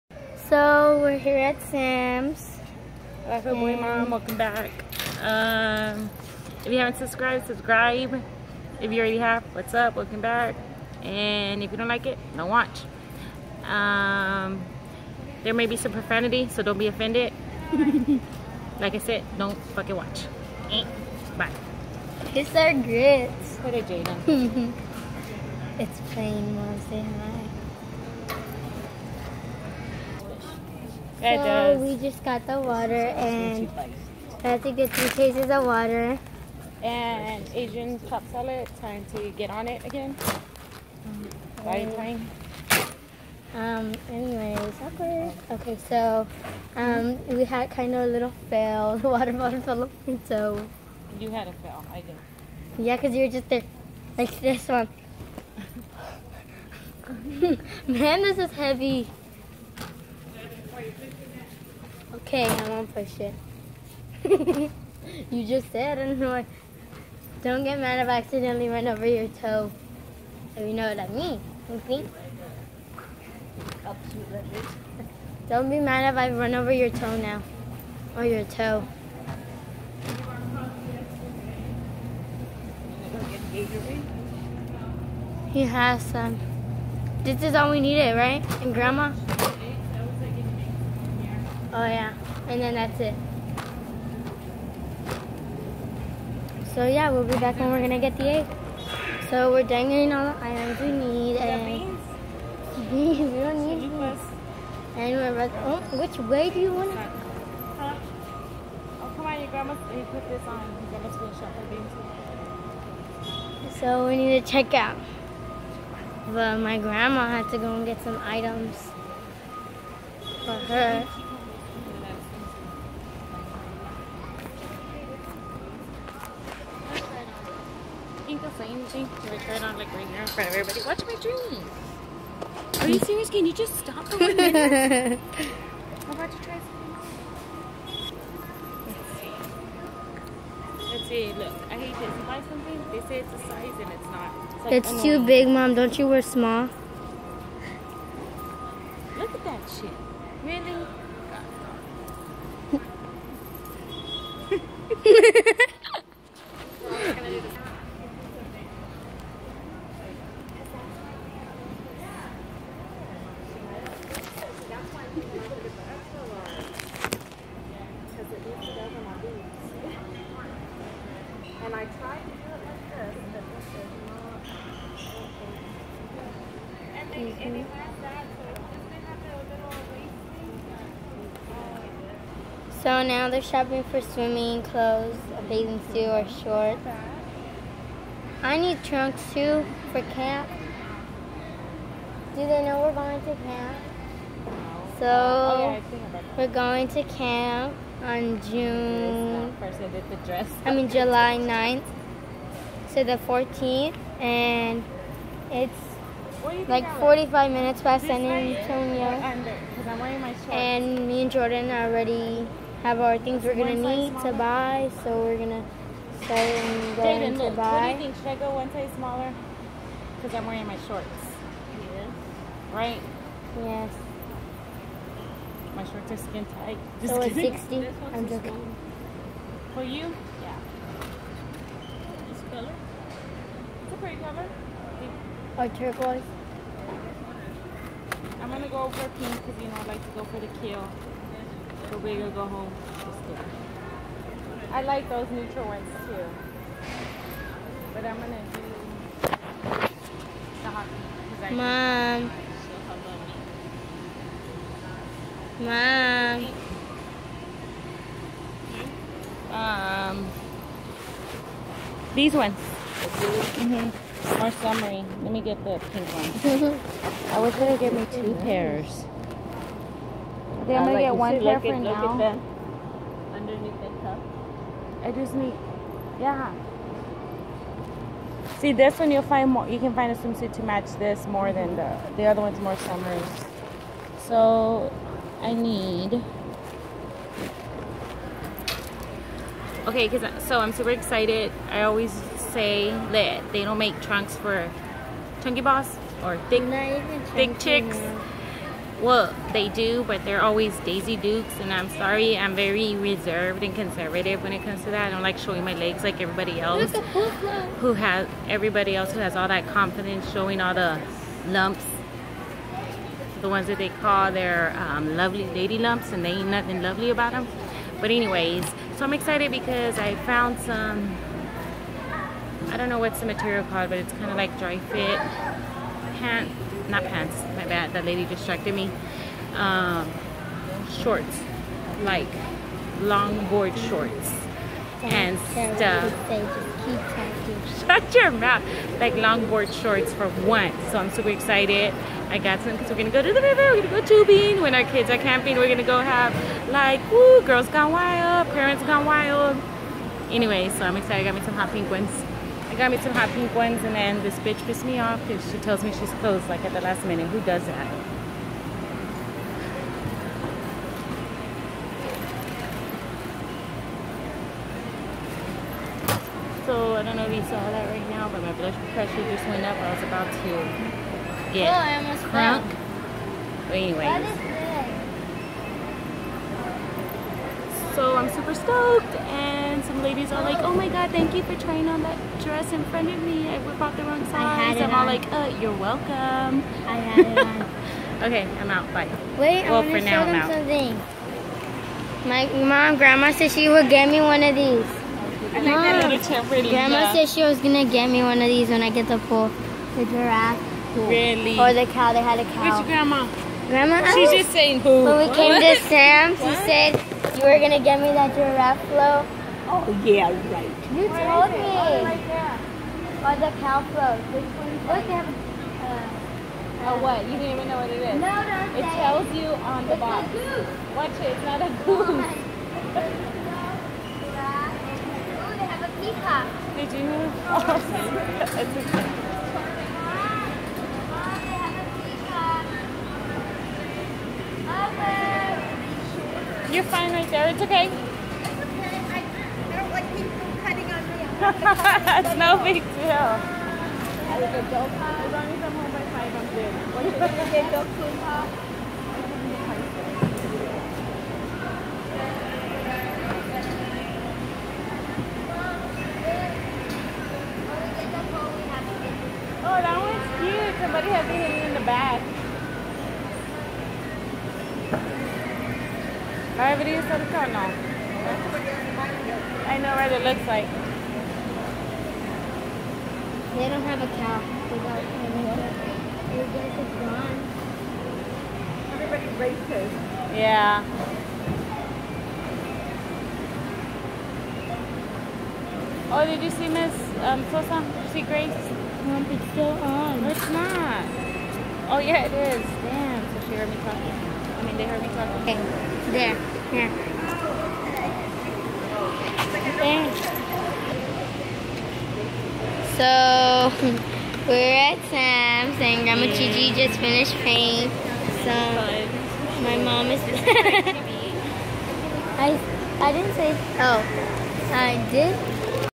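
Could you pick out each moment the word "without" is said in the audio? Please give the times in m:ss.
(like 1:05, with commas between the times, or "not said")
7:54.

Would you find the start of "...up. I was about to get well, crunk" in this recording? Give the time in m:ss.
6:09.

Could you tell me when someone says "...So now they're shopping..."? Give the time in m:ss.
3:02.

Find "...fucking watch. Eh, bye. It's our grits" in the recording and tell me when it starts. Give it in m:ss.
0:19.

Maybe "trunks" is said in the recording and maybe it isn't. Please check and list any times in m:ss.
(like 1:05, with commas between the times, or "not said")
3:08, 4:54.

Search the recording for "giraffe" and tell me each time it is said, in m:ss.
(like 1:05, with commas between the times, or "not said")
6:40, 6:48.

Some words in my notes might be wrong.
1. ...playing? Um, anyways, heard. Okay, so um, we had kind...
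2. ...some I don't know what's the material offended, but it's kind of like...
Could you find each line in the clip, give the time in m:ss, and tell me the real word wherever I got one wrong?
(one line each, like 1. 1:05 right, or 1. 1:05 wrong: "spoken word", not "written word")
1. 0:41 wrong: "awkward", not "heard"
2. 5:20 wrong: "called", not "offended".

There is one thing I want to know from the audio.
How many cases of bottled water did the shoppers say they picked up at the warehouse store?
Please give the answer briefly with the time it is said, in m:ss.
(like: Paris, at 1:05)
3, at 0:34.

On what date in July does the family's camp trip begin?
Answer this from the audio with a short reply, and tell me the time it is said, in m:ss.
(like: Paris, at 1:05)
July 9th, at 3:20.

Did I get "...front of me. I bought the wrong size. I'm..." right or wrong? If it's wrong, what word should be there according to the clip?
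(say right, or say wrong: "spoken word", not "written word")
right.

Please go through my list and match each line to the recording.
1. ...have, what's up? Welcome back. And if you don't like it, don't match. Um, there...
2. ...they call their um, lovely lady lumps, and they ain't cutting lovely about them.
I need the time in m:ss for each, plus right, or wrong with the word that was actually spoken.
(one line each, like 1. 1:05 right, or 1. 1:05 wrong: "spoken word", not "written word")
1. 0:09 wrong: "watch", not "match"
2. 5:13 wrong: "nothing", not "cutting".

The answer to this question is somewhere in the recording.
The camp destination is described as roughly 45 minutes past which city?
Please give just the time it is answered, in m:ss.
3:28.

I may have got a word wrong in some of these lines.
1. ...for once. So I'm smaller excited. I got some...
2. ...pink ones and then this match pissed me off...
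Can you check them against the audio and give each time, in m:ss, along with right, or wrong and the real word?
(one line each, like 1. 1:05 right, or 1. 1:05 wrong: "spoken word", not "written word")
1. 5:40 wrong: "super", not "smaller"
2. 5:53 wrong: "bitch", not "match".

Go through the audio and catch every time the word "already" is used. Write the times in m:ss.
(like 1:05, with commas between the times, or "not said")
0:08, 3:31.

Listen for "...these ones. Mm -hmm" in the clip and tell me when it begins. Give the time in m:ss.
4:22.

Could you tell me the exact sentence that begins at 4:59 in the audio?
Well, they do, but they're always Daisy Dukes, and I'm sorry, I'm very reserved and conservative when it comes to that.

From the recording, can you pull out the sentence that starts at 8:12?
Damn, so she heard me talking.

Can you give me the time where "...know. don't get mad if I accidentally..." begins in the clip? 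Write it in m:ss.
1:06.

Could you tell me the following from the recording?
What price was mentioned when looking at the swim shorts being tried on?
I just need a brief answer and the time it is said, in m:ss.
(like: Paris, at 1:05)
60, at 3:47.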